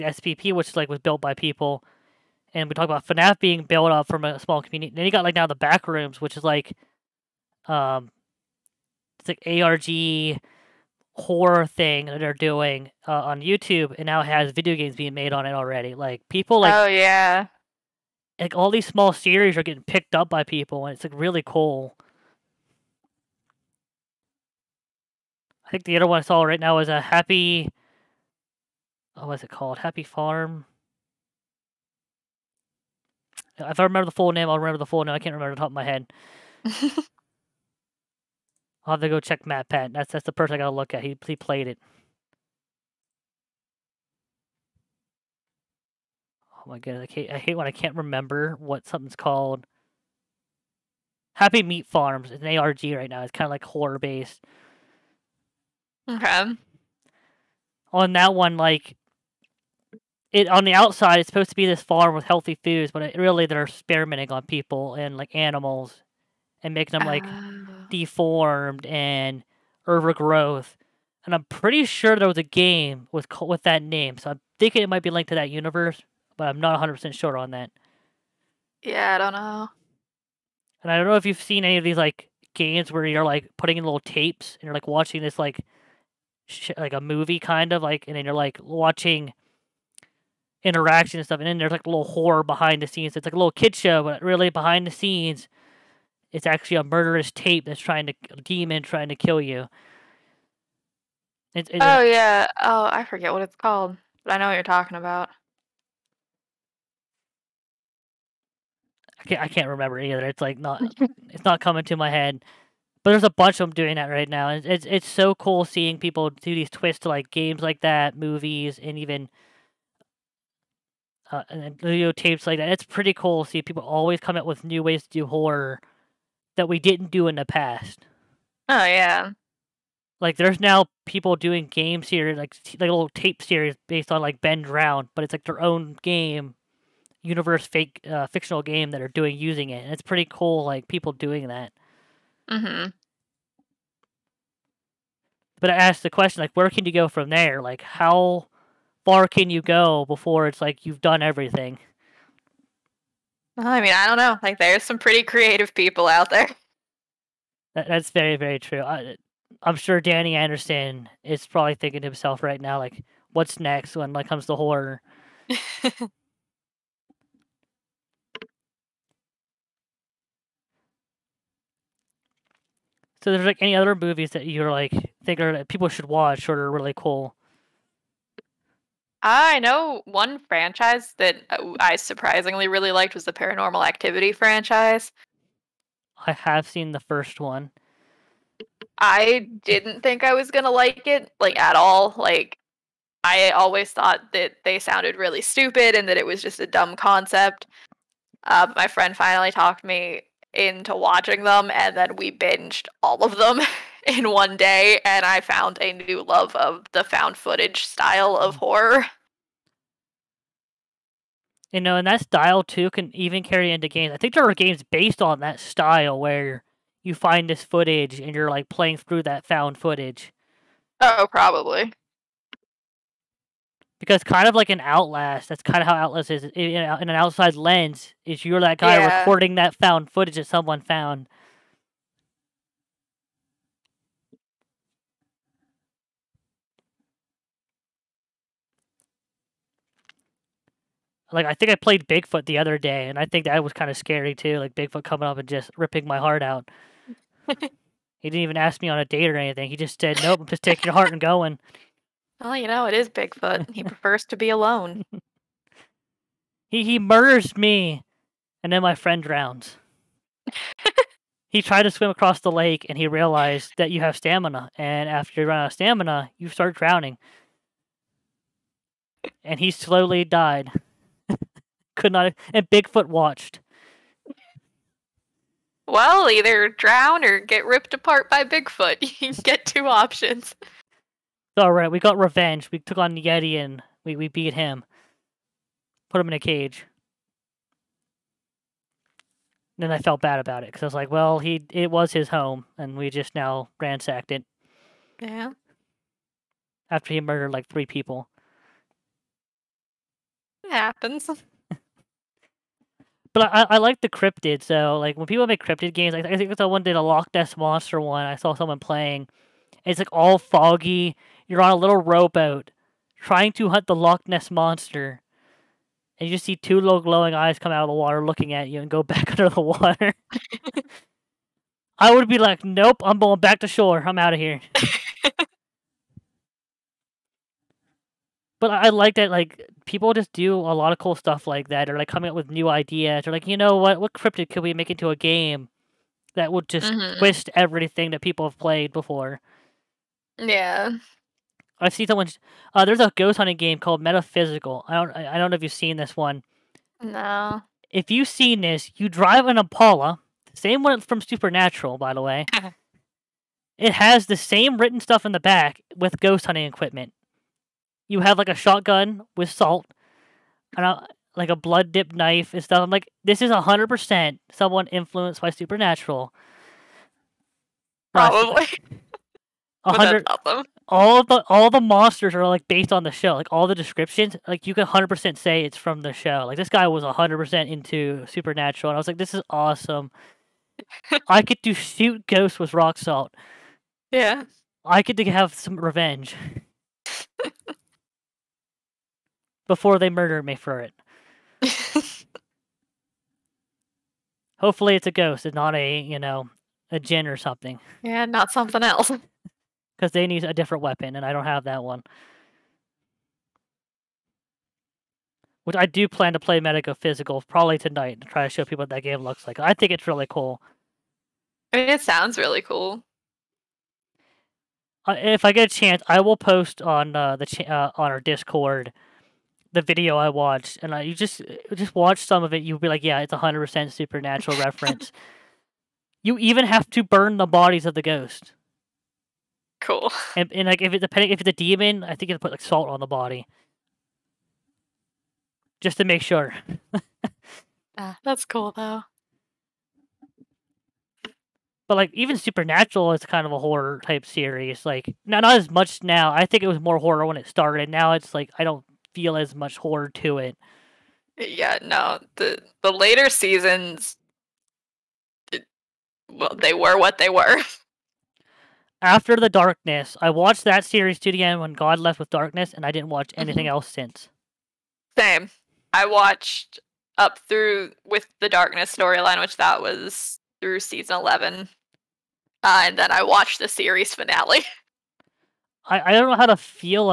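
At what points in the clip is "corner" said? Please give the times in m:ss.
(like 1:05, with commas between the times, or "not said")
not said.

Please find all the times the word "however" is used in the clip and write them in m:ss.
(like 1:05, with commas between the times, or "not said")
not said.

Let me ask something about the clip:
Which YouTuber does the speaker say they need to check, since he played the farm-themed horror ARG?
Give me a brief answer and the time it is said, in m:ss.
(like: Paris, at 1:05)
MatPat, at 0:39.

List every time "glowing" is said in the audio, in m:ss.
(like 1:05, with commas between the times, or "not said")
5:17.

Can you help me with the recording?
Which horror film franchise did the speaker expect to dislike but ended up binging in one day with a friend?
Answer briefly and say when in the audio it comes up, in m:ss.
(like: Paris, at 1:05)
Paranormal Activity, at 3:03.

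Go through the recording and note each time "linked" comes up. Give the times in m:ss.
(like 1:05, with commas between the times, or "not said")
1:15.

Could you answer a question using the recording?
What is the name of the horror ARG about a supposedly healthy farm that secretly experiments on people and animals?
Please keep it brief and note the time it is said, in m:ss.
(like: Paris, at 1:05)
Happy Meat Farms, at 0:51.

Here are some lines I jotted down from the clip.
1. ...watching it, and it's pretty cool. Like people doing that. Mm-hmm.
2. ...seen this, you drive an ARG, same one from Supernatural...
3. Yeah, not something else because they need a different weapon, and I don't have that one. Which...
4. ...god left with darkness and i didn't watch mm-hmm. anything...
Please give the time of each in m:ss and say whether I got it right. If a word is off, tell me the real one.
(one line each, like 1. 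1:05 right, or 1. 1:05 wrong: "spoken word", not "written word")
1. 2:19 wrong: "using", not "watching"
2. 5:48 wrong: "Impala", not "ARG"
3. 6:38 right
4. 7:41 right.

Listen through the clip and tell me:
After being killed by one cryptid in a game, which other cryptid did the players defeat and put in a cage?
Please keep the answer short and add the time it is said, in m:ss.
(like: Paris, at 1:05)
Yeti, at 4:43.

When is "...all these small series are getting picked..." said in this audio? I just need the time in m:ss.
0:18.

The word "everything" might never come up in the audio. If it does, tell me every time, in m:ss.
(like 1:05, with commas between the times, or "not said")
2:31, 5:37.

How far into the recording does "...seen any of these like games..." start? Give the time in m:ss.
1:21.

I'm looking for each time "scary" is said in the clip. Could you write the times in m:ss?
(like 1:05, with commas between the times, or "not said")
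4:03.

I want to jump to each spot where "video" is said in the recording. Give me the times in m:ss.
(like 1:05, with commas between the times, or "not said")
0:14, 6:59.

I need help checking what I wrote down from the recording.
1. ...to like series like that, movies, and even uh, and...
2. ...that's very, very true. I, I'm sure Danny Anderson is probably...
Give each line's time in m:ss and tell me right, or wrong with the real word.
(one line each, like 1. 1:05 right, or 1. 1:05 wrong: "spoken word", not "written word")
1. 1:57 wrong: "games", not "series"
2. 2:37 right.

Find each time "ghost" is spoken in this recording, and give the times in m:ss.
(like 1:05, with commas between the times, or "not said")
5:43, 5:56, 6:22, 6:35, 7:08.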